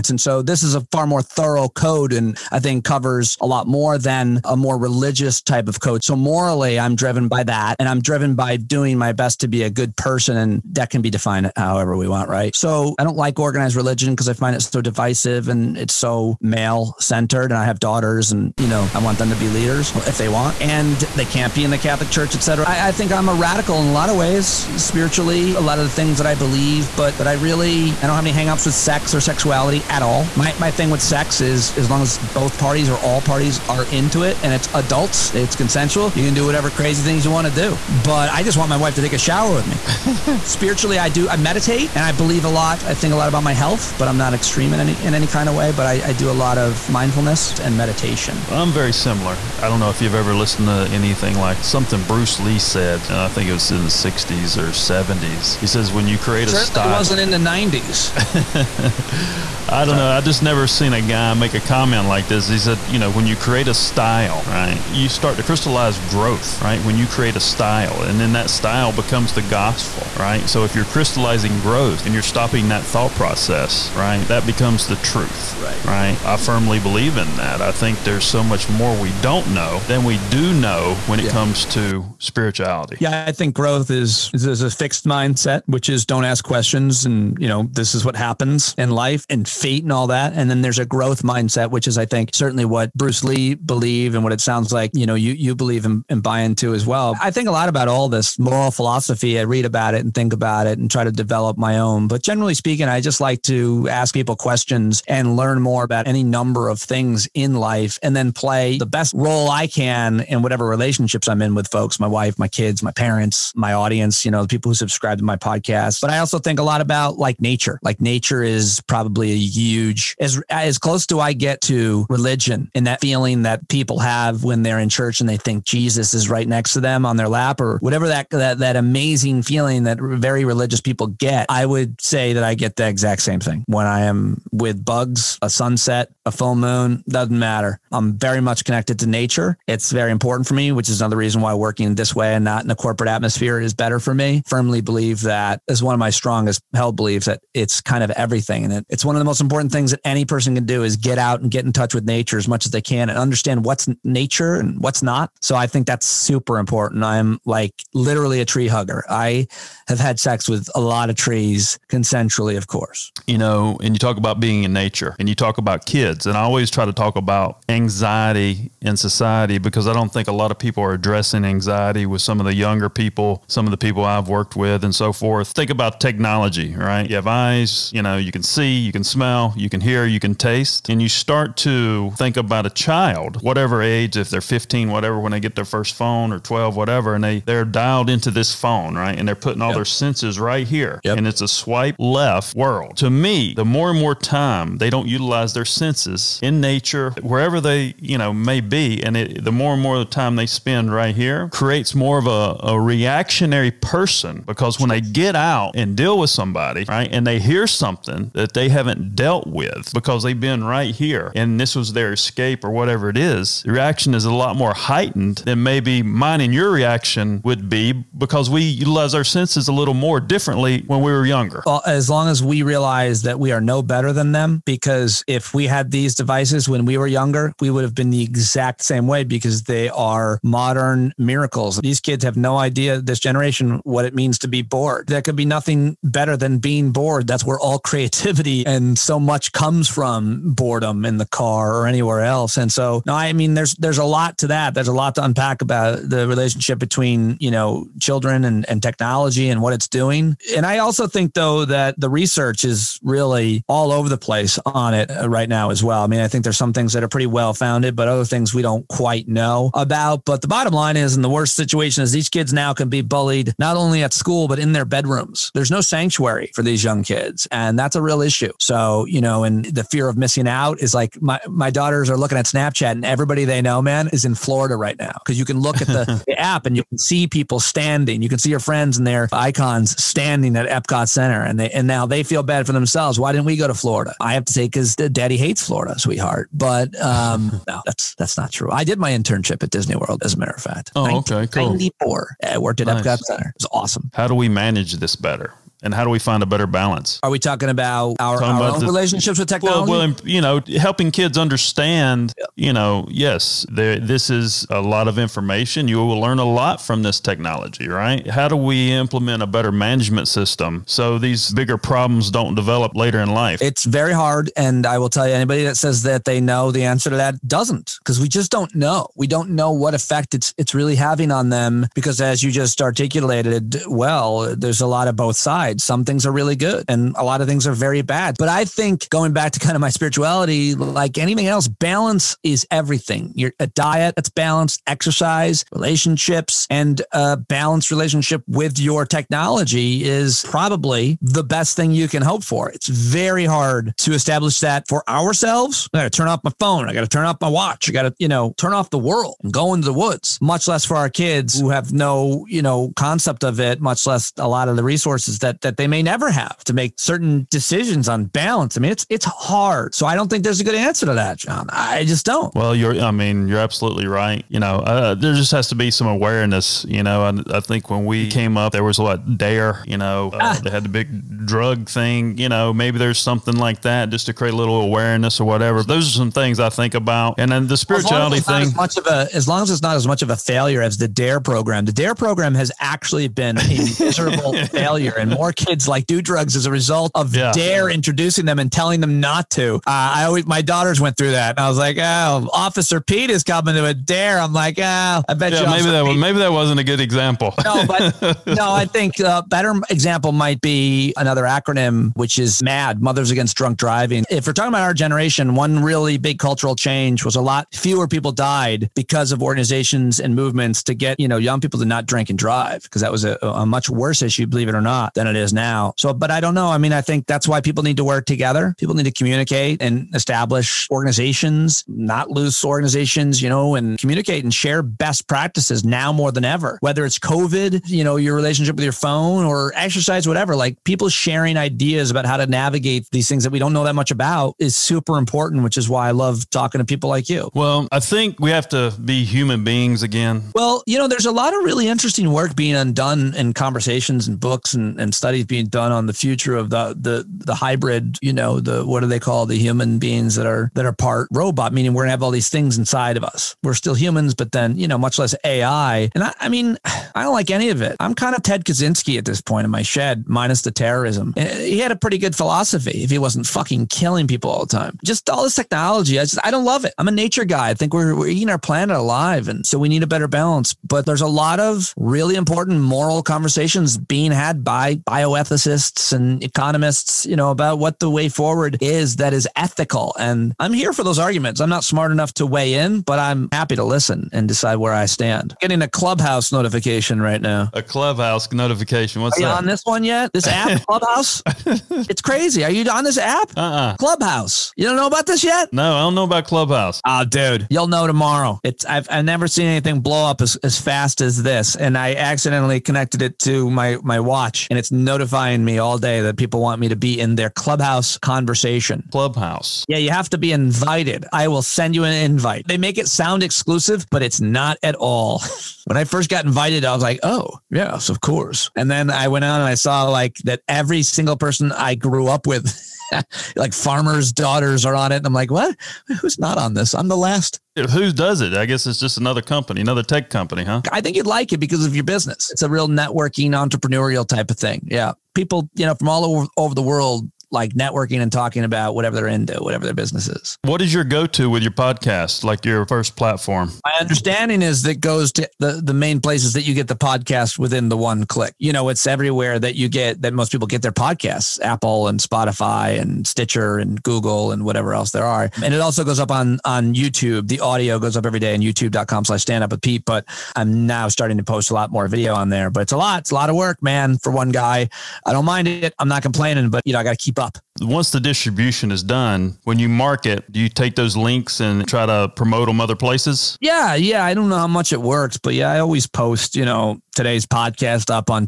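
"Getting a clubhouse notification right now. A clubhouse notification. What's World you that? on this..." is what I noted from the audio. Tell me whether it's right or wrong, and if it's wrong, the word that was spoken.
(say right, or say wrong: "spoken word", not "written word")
wrong: "Are", not "World".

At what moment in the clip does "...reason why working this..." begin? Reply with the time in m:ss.
2:21.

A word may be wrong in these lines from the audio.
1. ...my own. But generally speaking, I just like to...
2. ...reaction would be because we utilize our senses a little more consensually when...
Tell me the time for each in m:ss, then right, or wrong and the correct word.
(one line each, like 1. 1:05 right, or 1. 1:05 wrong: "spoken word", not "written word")
1. 1:41 right
2. 3:36 wrong: "differently", not "consensually".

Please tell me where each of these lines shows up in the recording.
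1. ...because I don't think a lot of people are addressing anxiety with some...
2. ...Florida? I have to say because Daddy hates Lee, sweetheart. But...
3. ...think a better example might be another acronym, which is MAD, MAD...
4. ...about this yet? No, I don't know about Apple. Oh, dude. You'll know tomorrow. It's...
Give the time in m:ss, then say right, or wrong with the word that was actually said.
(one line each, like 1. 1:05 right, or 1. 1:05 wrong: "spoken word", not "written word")
1. 2:49 right
2. 4:43 wrong: "Florida", not "Lee"
3. 6:38 wrong: "Mothers", not "MAD"
4. 8:15 wrong: "Clubhouse", not "Apple".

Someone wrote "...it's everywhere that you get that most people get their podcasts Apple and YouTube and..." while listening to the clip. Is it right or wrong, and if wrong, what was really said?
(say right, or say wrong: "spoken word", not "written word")
wrong: "Spotify", not "YouTube".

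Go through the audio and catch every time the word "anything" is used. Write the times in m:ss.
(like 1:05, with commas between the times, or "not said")
0:50, 5:31, 8:19.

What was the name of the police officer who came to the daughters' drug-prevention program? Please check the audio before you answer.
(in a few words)
Officer Pete.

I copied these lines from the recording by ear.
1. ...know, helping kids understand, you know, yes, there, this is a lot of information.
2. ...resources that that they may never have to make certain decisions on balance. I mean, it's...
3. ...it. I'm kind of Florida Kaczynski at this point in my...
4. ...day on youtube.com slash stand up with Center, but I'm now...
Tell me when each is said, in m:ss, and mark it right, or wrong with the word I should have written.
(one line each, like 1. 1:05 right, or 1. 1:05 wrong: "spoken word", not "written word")
1. 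5:00 right
2. 5:54 right
3. 7:37 wrong: "Ted", not "Florida"
4. 9:18 wrong: "Pete", not "Center".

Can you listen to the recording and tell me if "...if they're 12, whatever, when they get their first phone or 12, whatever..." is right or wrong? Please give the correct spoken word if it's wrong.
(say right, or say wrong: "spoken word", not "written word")
wrong: "15", not "12".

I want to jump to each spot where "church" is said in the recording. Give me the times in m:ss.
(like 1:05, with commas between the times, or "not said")
0:22, 2:04.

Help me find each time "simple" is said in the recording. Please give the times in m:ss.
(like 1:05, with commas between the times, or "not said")
not said.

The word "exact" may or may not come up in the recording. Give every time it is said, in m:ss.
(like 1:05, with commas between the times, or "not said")
2:12, 3:48.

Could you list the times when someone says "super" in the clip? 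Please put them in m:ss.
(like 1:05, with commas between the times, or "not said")
2:36, 7:14.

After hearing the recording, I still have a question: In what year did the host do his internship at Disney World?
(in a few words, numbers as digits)
1994.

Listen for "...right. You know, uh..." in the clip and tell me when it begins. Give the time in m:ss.
6:04.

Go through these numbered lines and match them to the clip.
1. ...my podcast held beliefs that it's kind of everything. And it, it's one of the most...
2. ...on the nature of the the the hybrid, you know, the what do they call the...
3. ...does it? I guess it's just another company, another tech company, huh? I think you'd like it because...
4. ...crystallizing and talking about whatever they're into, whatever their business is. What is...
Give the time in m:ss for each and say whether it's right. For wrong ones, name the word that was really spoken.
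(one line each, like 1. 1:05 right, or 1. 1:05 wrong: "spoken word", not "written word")
1. 2:25 wrong: "strongest", not "podcast"
2. 7:25 wrong: "future", not "nature"
3. 8:48 right
4. 8:57 wrong: "networking", not "crystallizing".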